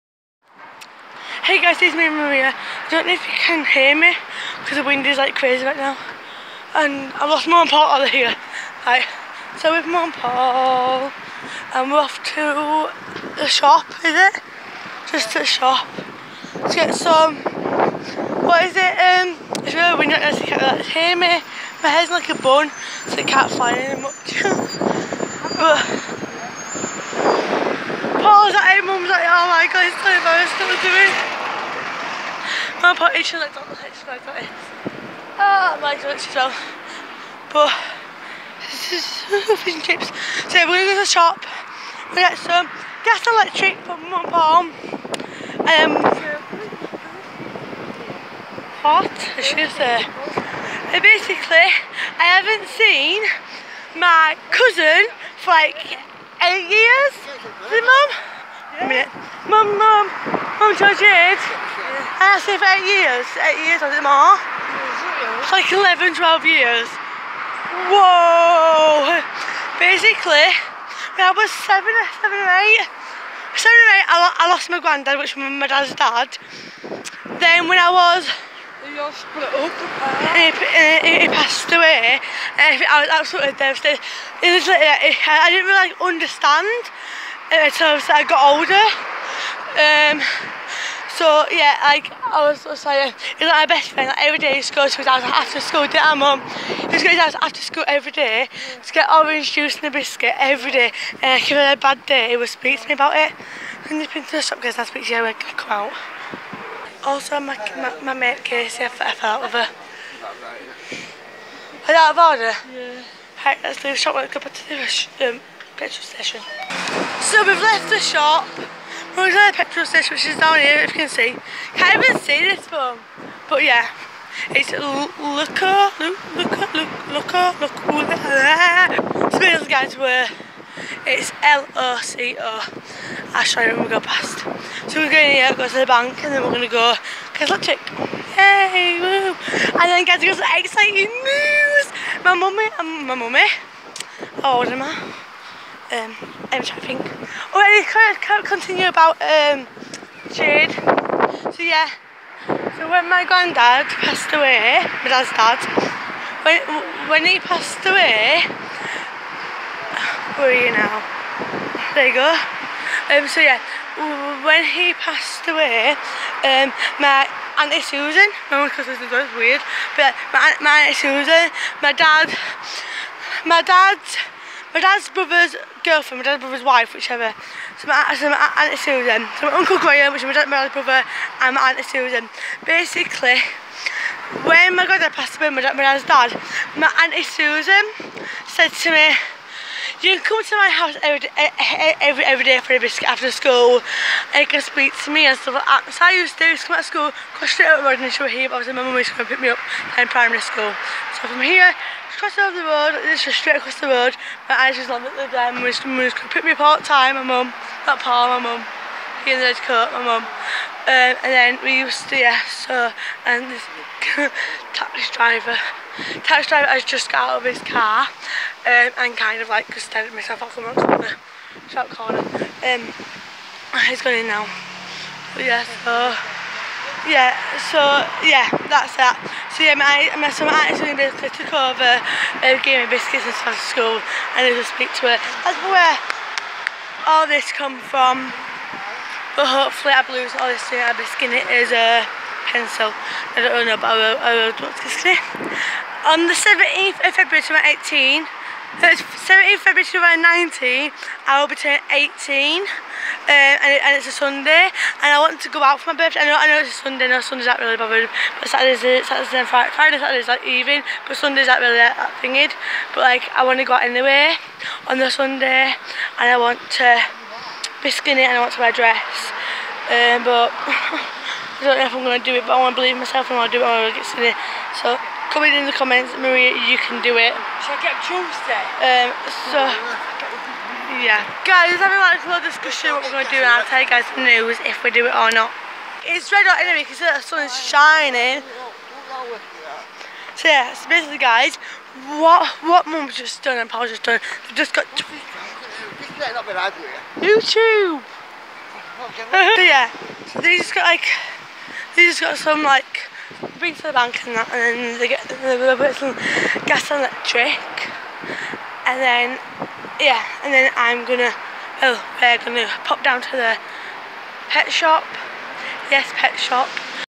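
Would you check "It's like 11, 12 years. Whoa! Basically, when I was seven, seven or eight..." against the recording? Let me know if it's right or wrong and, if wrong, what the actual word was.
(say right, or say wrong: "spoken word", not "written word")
right.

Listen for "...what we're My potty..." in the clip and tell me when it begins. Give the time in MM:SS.
00:30.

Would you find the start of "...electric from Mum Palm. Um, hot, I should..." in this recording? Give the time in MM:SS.
00:43.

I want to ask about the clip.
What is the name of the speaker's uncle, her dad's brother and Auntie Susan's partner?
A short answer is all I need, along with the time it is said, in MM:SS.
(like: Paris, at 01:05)
Graham, at 02:59.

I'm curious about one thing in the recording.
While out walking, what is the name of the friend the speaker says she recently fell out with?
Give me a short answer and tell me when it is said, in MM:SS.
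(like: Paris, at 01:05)
Casey, at 01:48.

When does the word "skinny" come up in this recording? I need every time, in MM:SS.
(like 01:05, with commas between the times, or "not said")
04:01, 04:27, 04:34.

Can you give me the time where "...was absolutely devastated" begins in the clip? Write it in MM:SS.
01:23.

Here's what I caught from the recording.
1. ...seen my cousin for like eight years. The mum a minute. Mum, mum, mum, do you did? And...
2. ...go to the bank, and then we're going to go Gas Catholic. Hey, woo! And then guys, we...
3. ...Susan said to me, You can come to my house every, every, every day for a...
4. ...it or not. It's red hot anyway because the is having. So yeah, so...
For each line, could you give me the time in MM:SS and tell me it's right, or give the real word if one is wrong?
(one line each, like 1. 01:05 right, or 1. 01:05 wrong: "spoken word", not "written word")
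1. 00:52 right
2. 02:15 wrong: "Cause", not "Gas"
3. 03:07 right
4. 04:45 wrong: "shining", not "having".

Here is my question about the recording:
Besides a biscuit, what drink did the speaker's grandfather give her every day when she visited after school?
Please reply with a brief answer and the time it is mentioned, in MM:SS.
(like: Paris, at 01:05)
Orange juice, at 01:39.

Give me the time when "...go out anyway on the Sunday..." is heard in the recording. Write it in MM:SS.
04:23.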